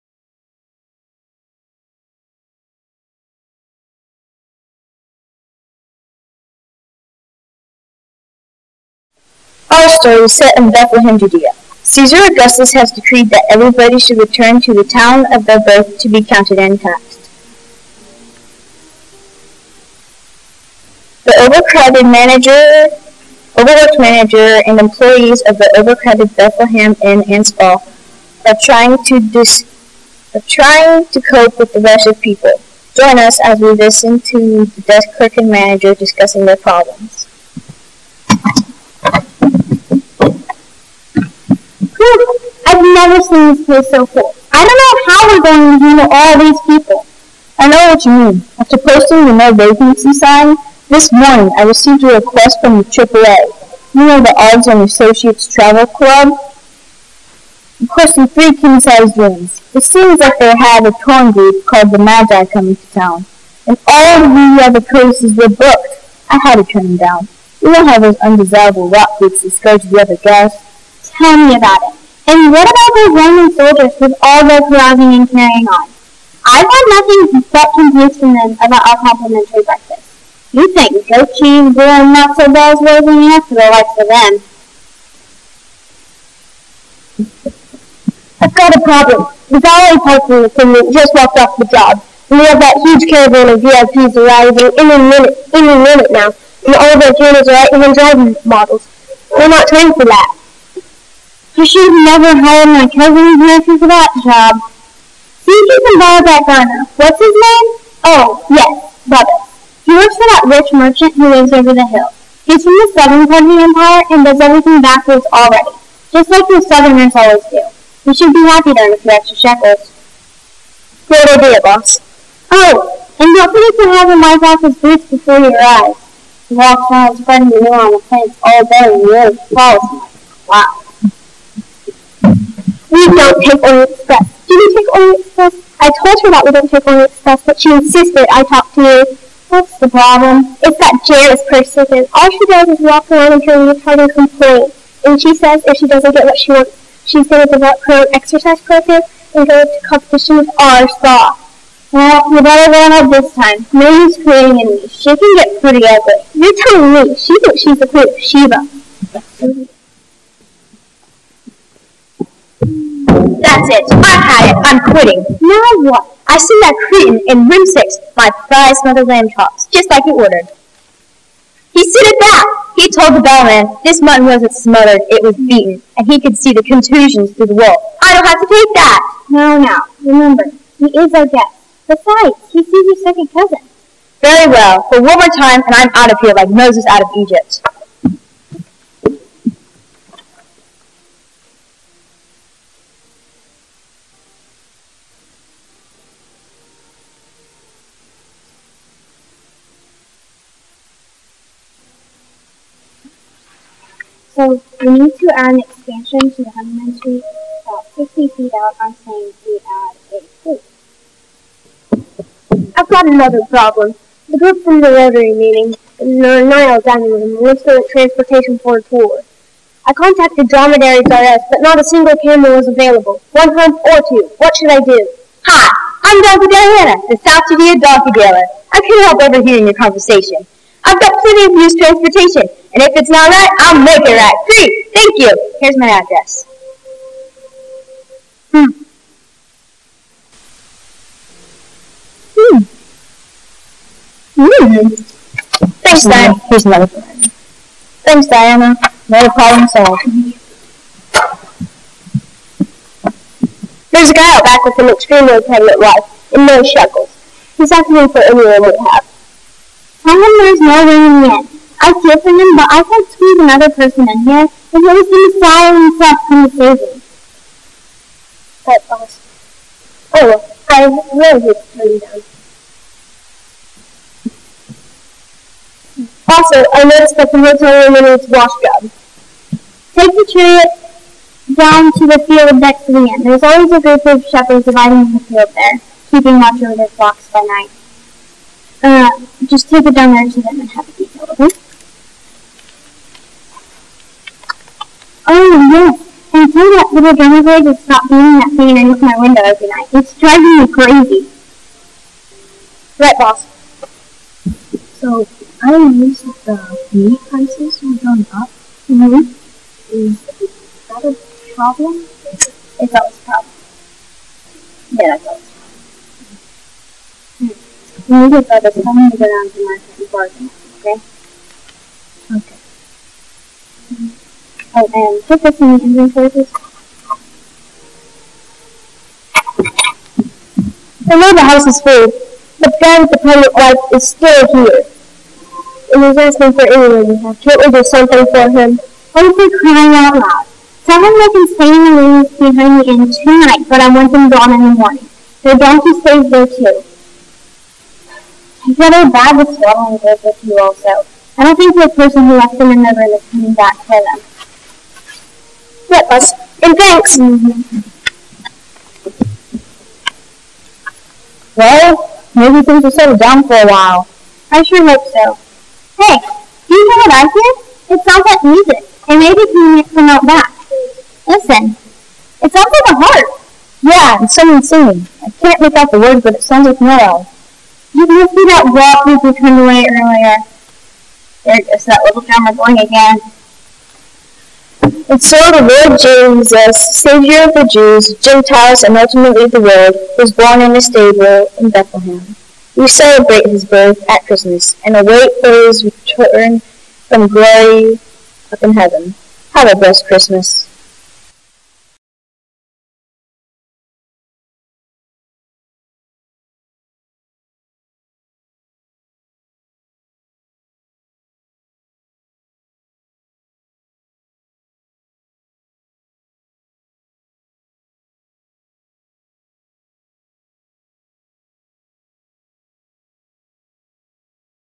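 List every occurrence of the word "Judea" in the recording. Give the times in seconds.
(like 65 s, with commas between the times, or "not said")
11 s, 227 s.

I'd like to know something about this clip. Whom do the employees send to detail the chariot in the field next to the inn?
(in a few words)
shepherds.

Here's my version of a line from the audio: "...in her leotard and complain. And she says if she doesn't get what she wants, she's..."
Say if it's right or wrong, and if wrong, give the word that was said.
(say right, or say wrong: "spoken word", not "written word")
right.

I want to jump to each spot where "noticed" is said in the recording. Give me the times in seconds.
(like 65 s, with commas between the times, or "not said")
276 s, 305 s.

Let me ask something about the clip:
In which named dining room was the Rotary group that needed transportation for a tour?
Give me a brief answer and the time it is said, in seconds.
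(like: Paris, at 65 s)
the Nile dining room, at 216 s.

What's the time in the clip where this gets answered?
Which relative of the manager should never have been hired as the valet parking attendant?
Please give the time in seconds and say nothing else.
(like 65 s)
102 s.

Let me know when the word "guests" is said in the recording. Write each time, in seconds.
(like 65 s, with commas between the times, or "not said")
70 s, 181 s.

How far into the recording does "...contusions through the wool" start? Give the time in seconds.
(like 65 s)
176 s.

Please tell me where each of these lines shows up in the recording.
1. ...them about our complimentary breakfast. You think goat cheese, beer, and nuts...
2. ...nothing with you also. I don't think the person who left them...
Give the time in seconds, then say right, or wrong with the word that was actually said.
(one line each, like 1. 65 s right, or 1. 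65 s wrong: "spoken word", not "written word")
1. 78 s right
2. 349 s wrong: "swallowing", not "nothing".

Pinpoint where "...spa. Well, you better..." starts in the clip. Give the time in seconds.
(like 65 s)
150 s.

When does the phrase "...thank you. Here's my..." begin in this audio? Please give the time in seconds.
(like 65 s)
234 s.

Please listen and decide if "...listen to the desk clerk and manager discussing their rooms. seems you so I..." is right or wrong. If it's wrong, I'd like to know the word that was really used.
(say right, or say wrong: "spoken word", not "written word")
wrong: "problems", not "rooms".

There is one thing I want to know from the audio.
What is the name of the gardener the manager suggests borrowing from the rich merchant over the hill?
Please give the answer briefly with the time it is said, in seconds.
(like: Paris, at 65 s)
Bubba, at 109 s.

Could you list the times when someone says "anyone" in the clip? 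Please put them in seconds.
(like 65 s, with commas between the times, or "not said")
258 s, 336 s.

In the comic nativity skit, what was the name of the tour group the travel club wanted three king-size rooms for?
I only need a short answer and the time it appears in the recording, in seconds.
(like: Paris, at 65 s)
the Magi, at 61 s.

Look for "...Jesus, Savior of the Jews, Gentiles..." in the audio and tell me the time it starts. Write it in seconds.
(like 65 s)
385 s.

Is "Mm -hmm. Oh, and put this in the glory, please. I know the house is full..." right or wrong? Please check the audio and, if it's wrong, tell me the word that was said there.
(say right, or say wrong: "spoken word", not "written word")
wrong: "inventory", not "glory".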